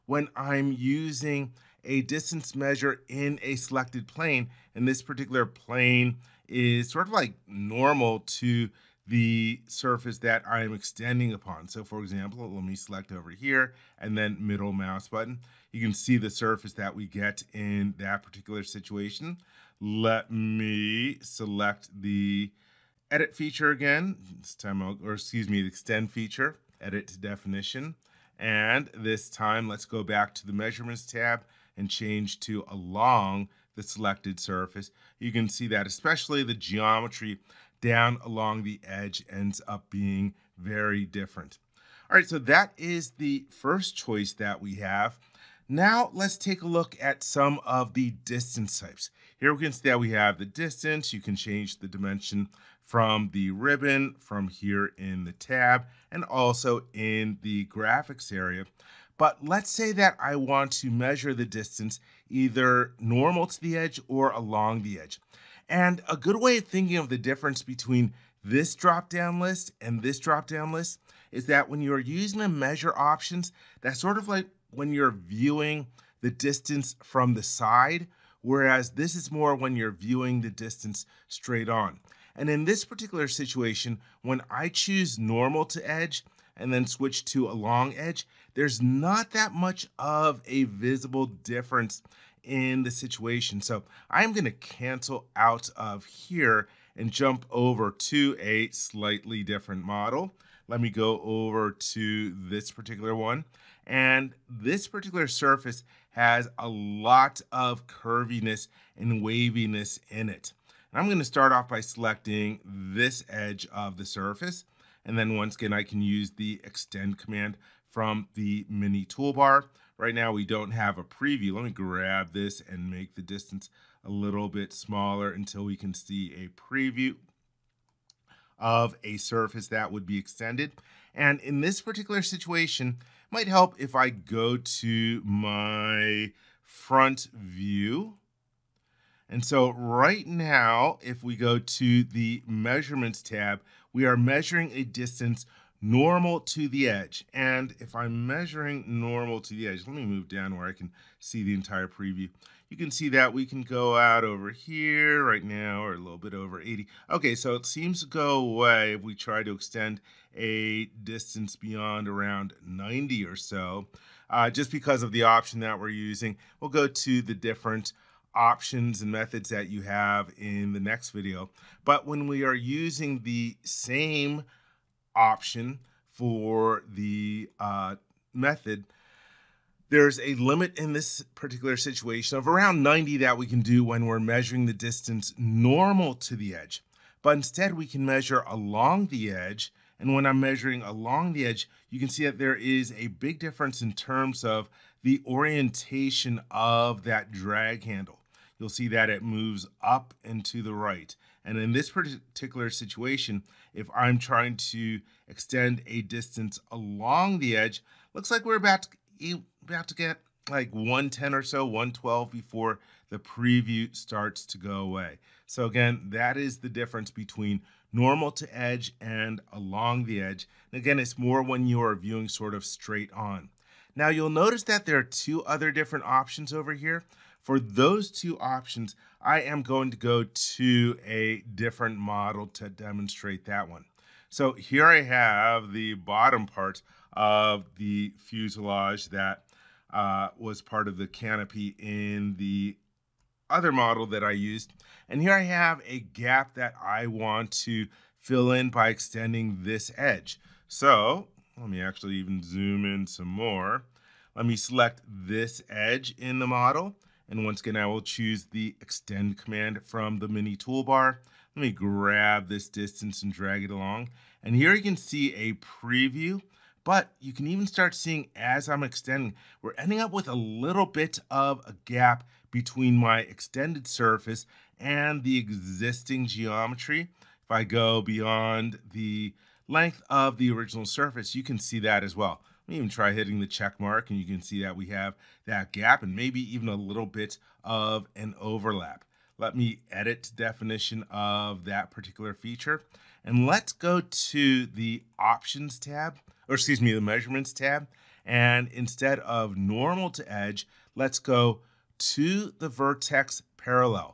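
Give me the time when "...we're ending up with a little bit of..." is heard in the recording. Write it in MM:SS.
04:29.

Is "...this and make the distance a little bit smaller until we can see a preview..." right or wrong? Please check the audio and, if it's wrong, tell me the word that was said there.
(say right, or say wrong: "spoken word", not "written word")
right.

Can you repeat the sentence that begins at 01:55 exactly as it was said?
And then once again, I can use the extend command from the mini toolbar.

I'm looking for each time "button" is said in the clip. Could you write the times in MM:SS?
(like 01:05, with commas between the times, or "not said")
00:15.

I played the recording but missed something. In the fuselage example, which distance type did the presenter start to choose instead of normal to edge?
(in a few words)
vertex parallel.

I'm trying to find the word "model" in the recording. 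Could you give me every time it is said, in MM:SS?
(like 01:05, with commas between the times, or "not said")
01:39, 03:51, 04:03, 04:16.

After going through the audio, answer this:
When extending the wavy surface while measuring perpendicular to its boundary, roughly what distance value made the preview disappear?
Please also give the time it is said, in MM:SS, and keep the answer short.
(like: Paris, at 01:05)
90, at 02:42.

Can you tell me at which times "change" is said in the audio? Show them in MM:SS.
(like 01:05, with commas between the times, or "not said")
00:31, 00:51.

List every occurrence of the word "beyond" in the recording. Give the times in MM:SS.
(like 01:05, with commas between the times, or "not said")
02:41, 04:38.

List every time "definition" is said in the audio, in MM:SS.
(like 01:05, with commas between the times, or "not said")
00:27, 04:50.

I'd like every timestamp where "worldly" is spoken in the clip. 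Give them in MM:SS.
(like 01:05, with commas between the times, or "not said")
not said.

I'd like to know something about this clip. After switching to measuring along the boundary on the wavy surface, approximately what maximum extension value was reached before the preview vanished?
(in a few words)
112.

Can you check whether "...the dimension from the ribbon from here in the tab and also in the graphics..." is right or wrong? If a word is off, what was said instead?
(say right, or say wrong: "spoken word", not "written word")
right.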